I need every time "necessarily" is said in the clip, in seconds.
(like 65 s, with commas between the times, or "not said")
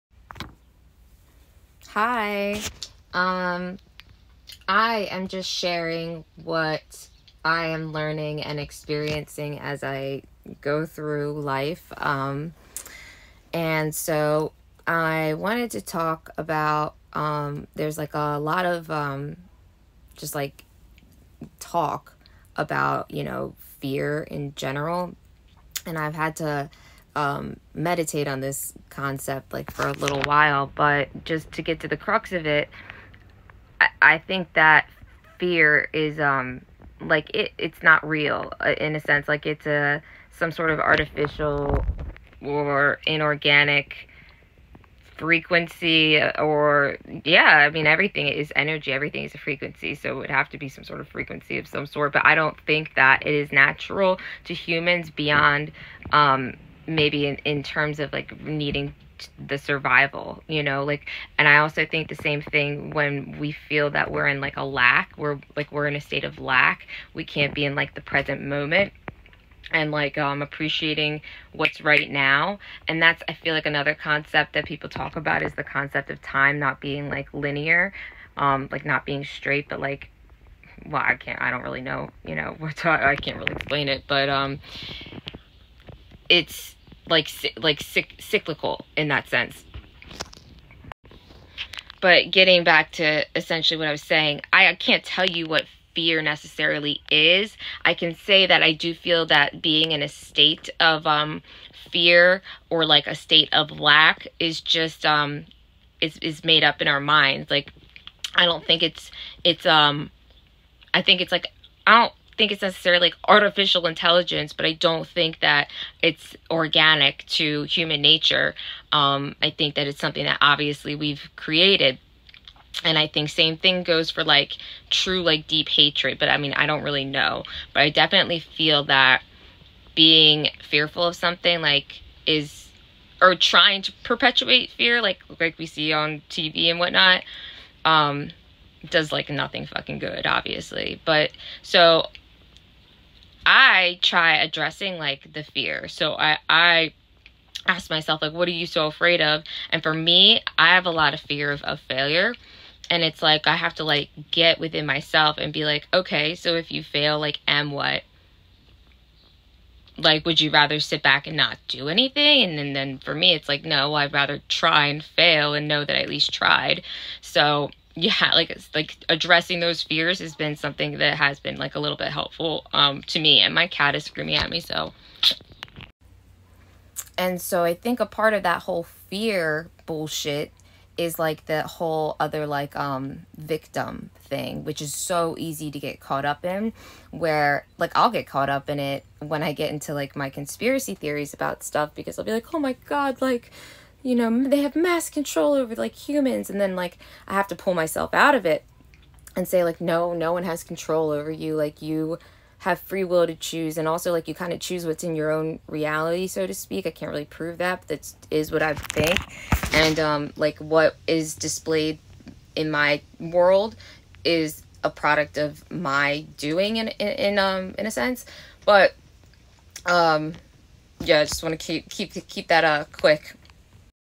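96 s, 112 s.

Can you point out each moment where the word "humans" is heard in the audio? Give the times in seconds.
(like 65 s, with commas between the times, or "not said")
54 s, 117 s, 195 s.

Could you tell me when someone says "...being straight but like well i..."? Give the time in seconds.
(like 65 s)
79 s.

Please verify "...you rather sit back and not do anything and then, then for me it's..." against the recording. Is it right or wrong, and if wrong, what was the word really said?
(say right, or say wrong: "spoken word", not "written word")
right.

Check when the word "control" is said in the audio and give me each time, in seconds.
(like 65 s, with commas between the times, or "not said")
195 s, 200 s.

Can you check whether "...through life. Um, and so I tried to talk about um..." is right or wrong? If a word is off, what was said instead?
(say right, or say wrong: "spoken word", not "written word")
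wrong: "wanted", not "tried".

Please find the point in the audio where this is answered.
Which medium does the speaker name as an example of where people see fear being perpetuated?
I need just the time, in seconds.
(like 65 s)
136 s.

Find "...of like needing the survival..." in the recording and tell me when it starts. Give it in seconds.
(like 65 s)
57 s.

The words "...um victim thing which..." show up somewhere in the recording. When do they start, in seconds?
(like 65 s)
182 s.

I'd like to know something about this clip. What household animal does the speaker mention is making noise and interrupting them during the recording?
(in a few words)
cat.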